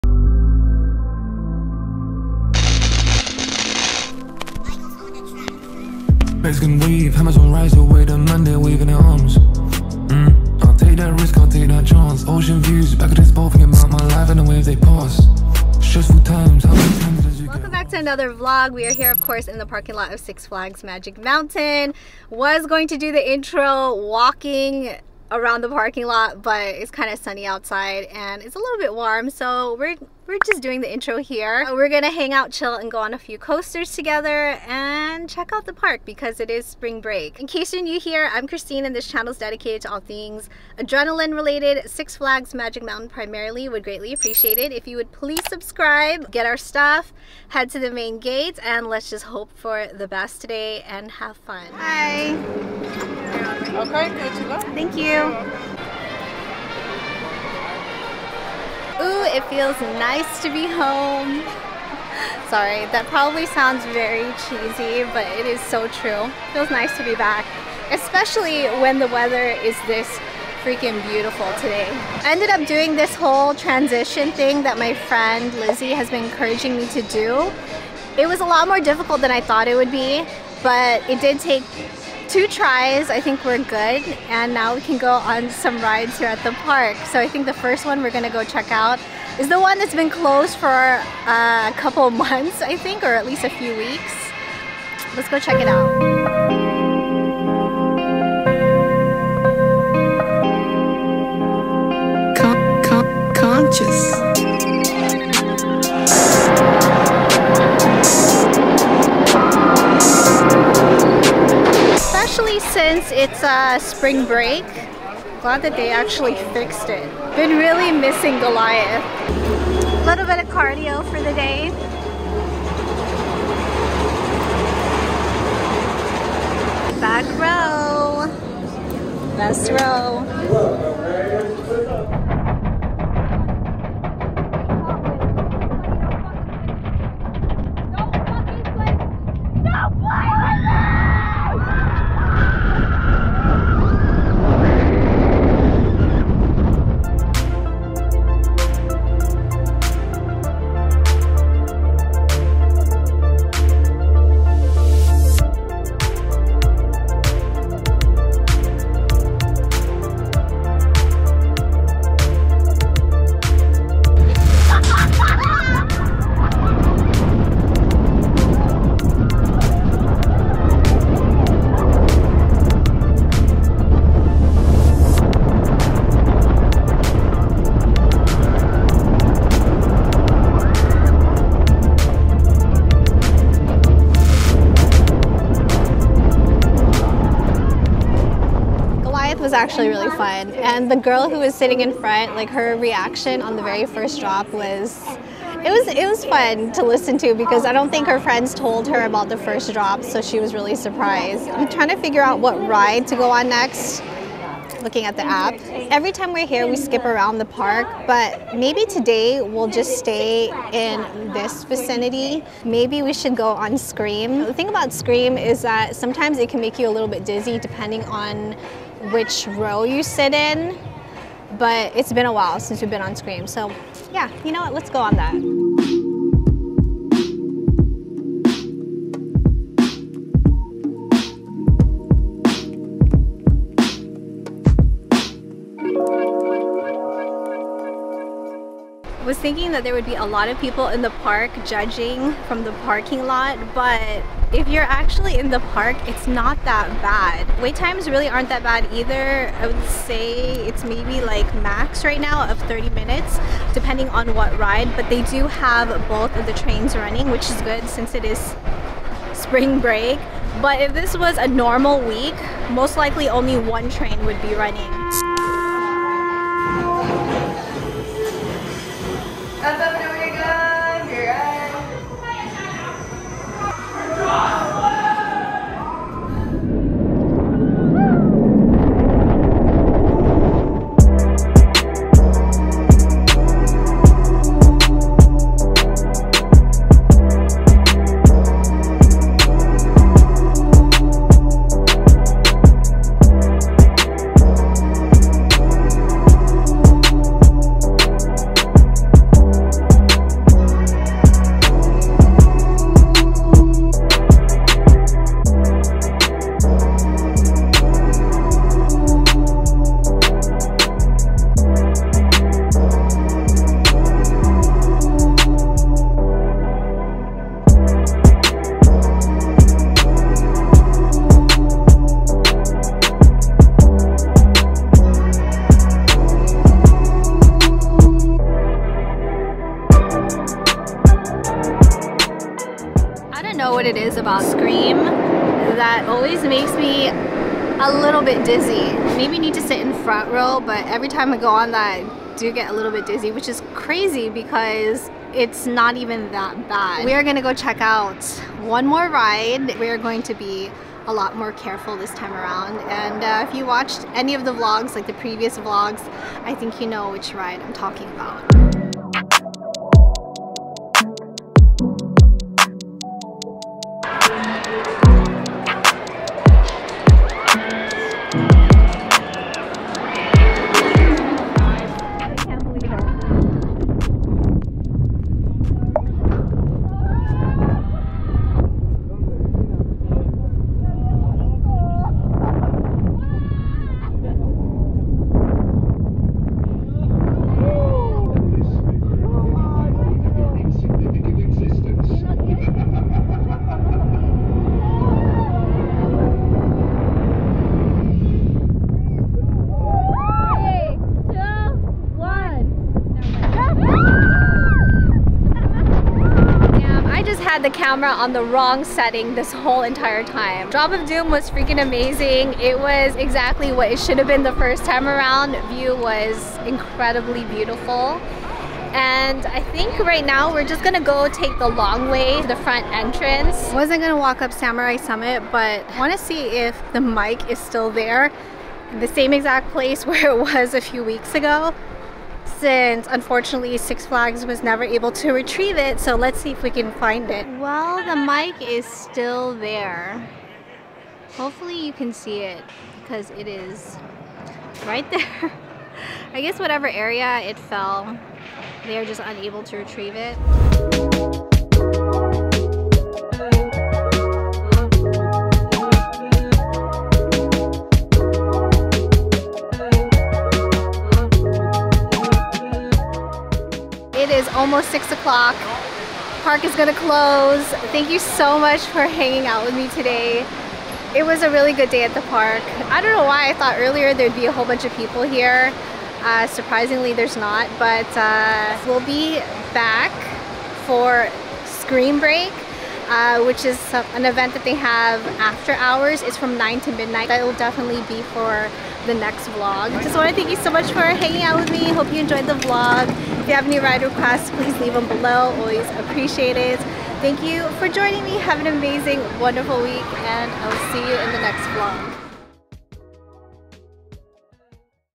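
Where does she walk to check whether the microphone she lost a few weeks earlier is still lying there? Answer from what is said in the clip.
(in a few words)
Samurai Summit.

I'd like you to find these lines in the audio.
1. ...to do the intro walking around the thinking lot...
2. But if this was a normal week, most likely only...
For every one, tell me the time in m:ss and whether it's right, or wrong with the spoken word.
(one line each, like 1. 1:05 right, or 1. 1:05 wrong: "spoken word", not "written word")
1. 0:22 wrong: "parking", not "thinking"
2. 4:20 right.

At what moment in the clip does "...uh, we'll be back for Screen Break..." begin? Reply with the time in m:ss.
7:58.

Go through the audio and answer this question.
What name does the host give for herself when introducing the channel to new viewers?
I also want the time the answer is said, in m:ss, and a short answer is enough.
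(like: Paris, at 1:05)
Christine, at 0:38.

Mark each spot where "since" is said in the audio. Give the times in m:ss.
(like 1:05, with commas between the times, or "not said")
1:52, 3:42, 4:17, 7:12.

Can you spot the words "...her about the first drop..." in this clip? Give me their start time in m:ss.
3:18.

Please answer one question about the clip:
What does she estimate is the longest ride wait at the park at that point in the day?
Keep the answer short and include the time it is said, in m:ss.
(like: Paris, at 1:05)
30 minutes, at 4:12.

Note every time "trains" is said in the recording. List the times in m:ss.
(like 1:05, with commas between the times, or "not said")
4:16, 4:23.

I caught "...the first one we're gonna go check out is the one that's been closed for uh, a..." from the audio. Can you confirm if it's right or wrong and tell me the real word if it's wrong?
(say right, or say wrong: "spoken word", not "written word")
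right.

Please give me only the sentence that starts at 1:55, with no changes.
Glad that they actually fixed it.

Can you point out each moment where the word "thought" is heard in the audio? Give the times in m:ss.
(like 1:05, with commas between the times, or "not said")
1:19, 7:53.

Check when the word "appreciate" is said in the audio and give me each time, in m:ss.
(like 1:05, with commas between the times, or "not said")
0:44, 8:16.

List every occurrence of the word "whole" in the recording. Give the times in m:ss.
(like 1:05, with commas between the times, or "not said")
1:13, 6:49, 7:54.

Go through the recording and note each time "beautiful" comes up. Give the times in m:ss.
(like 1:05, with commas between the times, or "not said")
1:11, 6:57.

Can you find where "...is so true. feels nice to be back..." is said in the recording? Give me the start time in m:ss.
1:05.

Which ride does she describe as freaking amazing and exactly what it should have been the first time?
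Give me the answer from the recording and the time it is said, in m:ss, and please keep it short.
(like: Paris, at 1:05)
Drop of Doom, at 6:50.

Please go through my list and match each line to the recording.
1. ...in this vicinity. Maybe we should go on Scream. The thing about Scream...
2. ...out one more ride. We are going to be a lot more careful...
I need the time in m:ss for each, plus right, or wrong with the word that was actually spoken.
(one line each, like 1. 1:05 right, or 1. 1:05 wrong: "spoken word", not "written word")
1. 3:30 right
2. 5:47 right.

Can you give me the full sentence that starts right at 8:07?
That will definitely be for the next vlog.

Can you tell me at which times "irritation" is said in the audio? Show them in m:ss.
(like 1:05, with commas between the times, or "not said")
not said.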